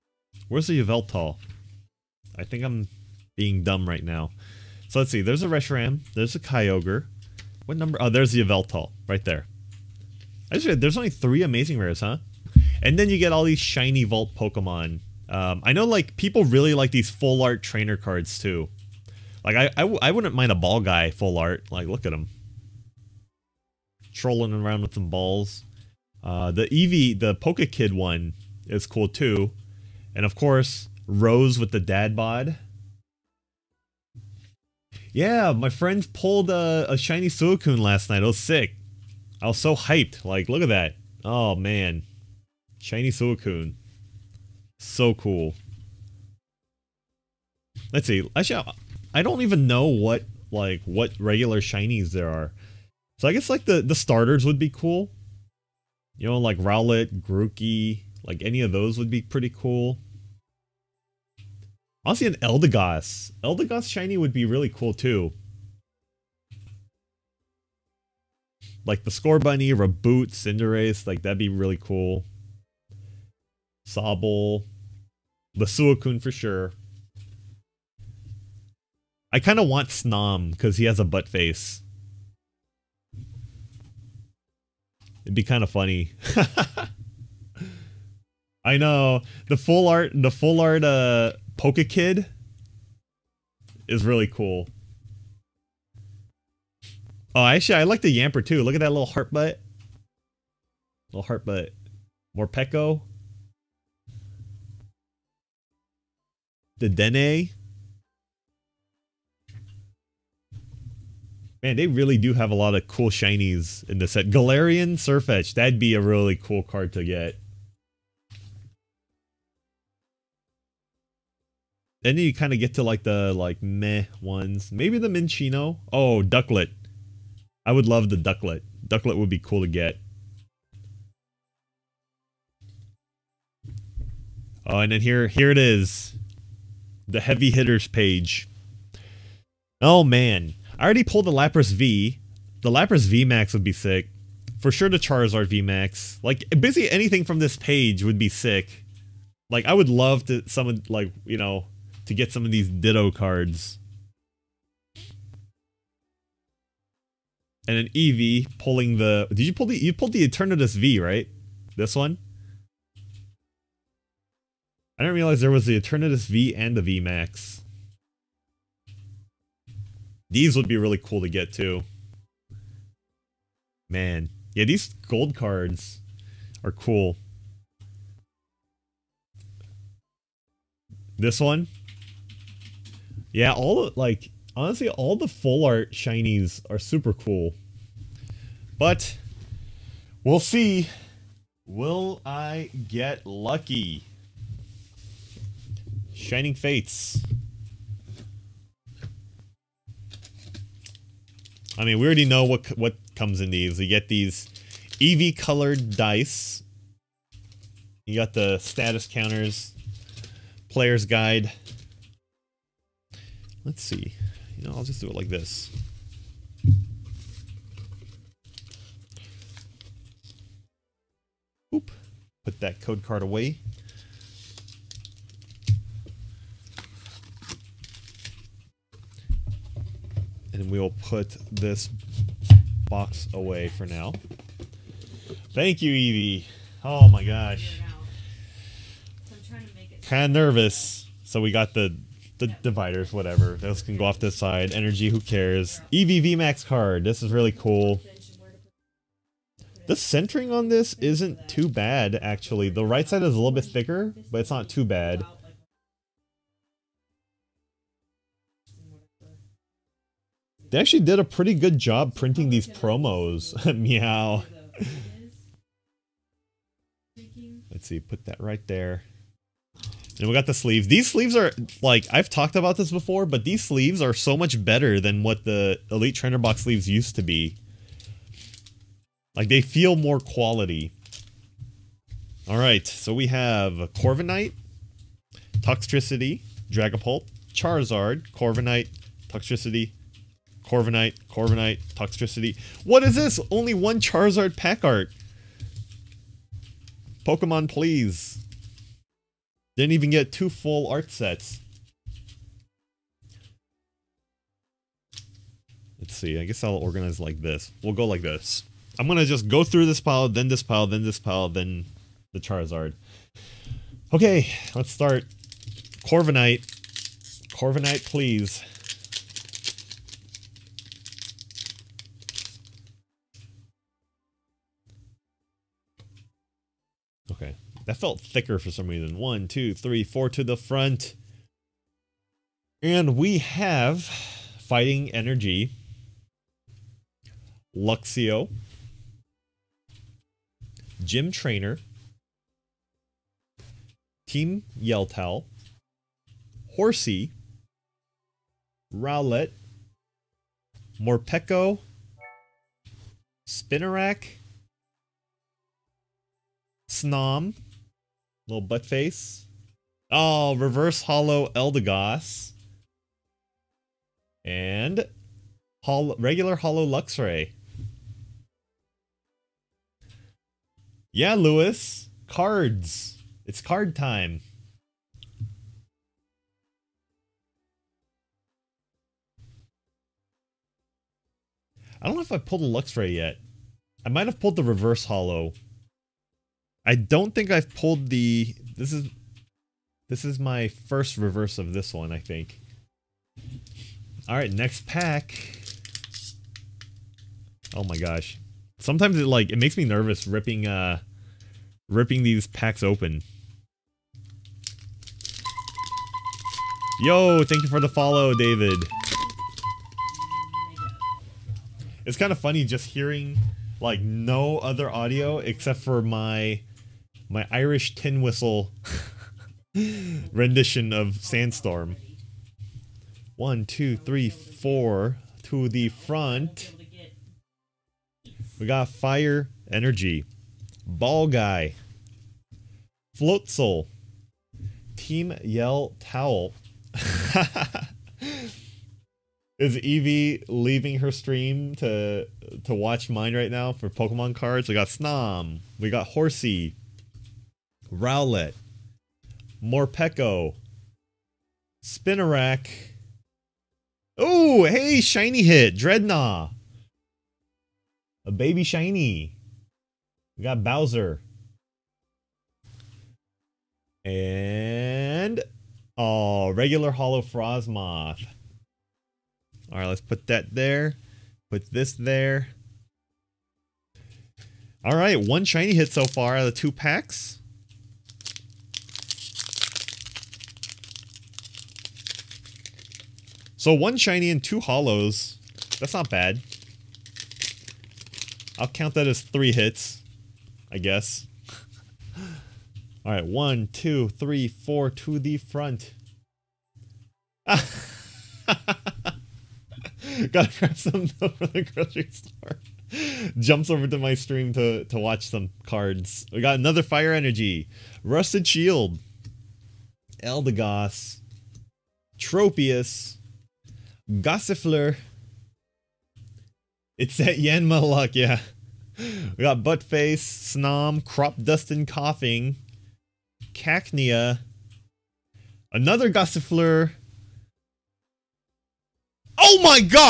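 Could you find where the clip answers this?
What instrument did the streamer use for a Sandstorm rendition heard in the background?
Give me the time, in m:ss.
6:57.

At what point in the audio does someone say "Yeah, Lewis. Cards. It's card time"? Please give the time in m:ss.
6:11.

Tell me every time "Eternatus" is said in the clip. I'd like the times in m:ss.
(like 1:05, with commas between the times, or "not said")
2:40, 2:45.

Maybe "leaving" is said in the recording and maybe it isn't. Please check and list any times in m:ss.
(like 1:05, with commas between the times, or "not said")
7:20.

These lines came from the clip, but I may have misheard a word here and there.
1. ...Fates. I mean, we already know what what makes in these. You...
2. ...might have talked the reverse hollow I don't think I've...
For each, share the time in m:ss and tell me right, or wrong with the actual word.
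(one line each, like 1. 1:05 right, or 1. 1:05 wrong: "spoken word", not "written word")
1. 3:16 wrong: "comes", not "makes"
2. 6:24 wrong: "pulled", not "talked".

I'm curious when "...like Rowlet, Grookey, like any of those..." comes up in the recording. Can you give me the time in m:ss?
0:56.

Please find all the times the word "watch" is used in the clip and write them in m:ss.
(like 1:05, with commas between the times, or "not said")
7:22, 8:25.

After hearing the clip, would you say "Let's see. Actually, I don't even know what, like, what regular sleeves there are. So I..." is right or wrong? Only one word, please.
wrong.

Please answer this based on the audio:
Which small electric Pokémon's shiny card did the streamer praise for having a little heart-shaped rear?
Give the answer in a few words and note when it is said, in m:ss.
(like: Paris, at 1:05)
Yamper, at 1:38.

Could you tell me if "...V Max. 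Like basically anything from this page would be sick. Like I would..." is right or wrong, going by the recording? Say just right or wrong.
right.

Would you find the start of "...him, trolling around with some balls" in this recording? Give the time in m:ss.
0:22.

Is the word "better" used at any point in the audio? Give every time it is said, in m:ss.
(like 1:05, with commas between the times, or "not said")
4:34.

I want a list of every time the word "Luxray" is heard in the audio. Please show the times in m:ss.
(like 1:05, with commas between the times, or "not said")
6:06, 6:22.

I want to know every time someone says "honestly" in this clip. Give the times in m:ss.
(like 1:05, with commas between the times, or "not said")
1:02, 3:04.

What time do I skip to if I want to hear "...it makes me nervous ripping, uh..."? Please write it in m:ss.
6:39.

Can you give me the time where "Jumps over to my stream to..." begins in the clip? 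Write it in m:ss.
8:23.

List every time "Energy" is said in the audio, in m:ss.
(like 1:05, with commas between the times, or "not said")
4:04, 5:35, 7:09, 8:27.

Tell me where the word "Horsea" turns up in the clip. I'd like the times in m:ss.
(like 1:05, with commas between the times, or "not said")
5:46, 7:26.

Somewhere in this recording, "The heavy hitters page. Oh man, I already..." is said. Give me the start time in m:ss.
2:17.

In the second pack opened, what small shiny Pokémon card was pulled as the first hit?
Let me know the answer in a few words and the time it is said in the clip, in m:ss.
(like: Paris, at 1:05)
Drednaw, at 7:35.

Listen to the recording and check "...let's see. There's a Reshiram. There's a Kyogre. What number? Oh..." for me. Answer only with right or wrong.
right.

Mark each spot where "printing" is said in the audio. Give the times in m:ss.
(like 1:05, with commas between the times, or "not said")
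4:22.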